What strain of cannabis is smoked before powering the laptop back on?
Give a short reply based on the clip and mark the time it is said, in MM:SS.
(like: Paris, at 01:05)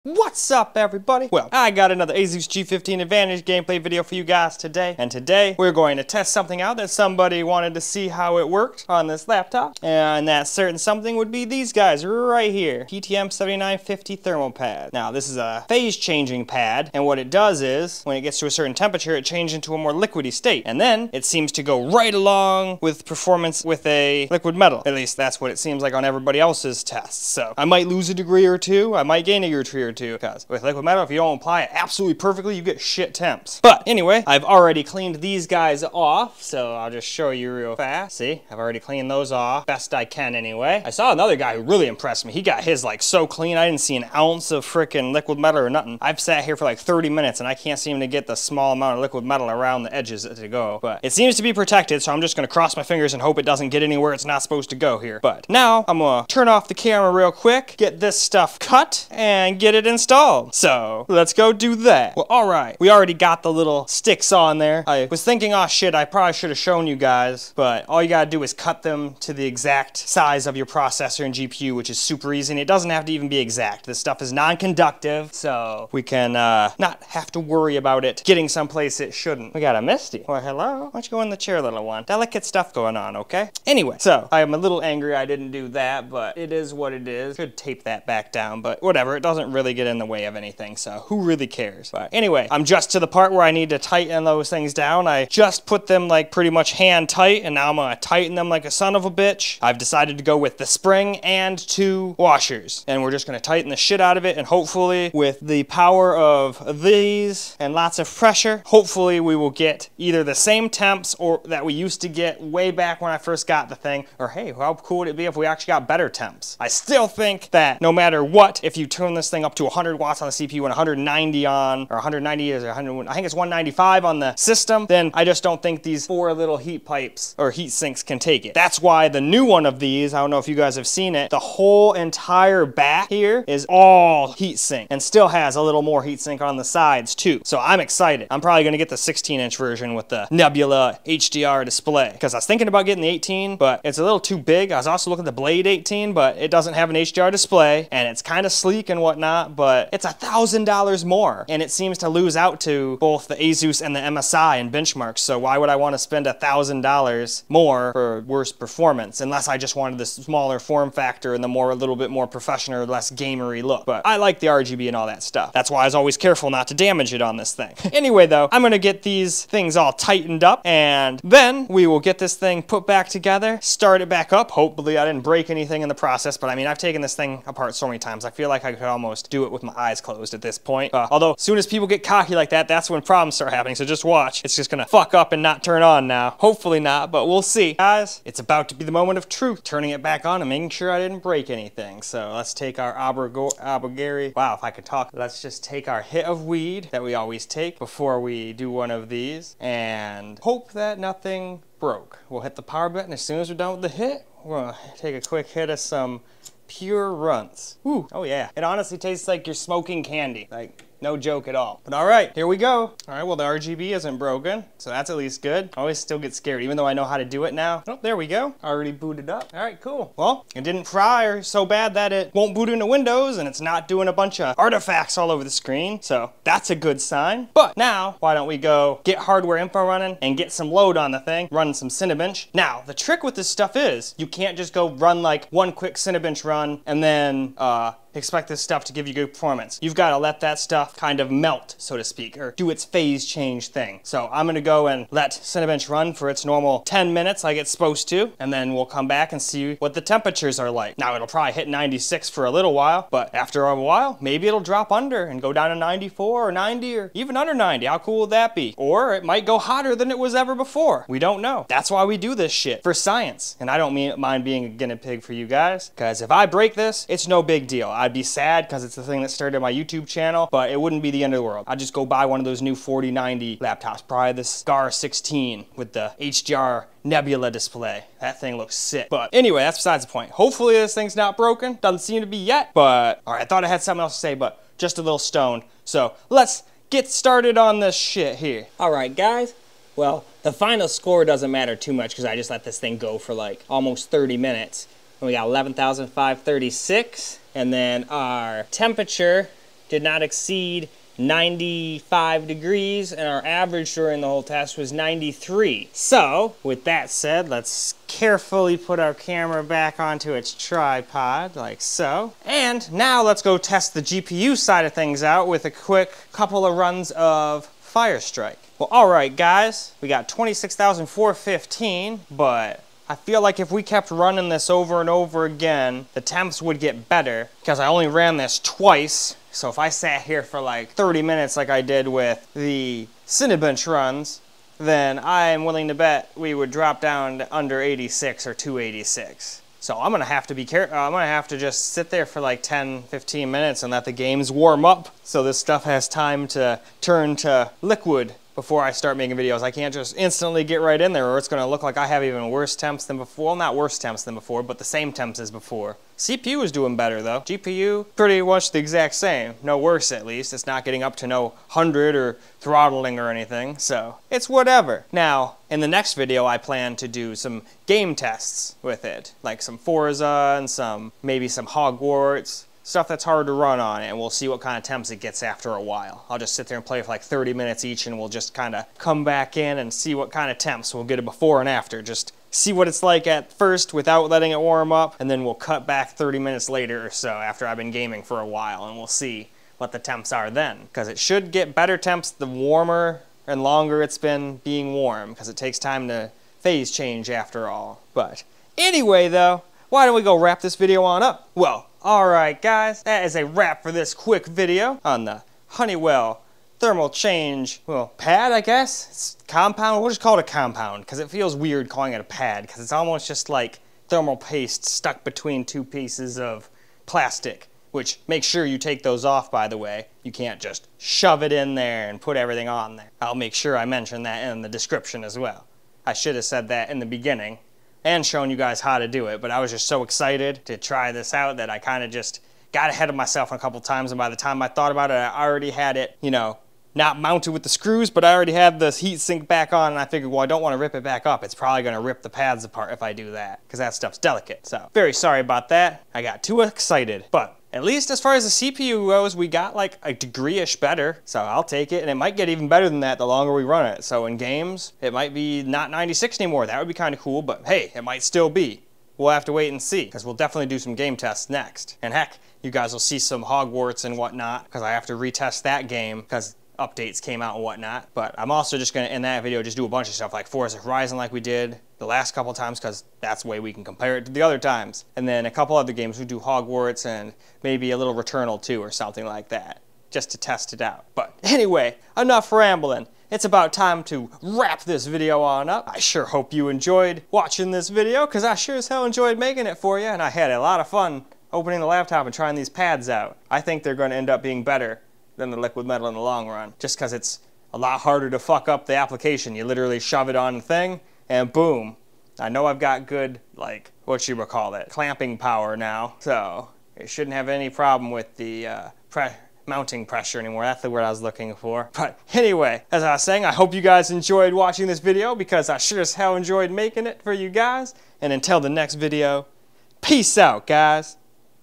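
Runts, at 03:27.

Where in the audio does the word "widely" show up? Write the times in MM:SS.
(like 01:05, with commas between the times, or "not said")
not said.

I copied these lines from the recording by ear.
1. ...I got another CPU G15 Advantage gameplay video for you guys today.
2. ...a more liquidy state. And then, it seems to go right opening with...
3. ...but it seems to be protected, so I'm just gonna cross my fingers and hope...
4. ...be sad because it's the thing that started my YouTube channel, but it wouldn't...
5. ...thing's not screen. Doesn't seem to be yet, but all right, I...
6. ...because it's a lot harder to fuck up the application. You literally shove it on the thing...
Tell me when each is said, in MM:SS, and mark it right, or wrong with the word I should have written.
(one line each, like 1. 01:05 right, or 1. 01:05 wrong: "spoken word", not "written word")
1. 00:01 wrong: "ASUS", not "CPU"
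2. 00:19 wrong: "along", not "opening"
3. 00:50 right
4. 04:28 right
5. 04:40 wrong: "broken", not "screen"
6. 08:16 right.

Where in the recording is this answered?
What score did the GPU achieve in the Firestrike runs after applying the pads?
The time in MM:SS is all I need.
05:20.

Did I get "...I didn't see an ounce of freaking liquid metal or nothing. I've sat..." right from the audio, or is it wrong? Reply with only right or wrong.
right.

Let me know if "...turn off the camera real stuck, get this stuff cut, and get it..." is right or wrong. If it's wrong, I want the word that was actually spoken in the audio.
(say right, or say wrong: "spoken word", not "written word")
wrong: "quick", not "stuck".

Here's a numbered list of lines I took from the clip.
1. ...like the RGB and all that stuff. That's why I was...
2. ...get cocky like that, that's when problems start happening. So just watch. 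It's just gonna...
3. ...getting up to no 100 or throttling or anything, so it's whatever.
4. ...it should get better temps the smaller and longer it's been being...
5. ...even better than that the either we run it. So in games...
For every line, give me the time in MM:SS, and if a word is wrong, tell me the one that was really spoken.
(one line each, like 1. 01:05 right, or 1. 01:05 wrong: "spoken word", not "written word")
1. 02:44 right
2. 03:01 right
3. 06:00 right
4. 06:31 wrong: "warmer", not "smaller"
5. 07:32 wrong: "longer", not "either".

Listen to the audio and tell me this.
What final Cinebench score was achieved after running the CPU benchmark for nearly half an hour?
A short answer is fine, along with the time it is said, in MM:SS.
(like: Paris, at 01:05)
11,536, at 04:55.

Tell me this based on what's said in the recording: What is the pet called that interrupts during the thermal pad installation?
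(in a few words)
Misty.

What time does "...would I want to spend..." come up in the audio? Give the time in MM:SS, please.
02:35.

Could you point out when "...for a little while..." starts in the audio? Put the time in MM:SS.
04:12.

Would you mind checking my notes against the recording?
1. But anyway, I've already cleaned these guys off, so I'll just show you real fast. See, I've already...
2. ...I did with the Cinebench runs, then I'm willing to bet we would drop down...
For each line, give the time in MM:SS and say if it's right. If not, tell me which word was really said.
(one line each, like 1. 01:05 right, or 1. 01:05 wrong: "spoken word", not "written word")
1. 00:33 right
2. 05:31 right.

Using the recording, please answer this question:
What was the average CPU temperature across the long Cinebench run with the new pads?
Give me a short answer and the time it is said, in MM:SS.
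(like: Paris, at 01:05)
93, at 05:04.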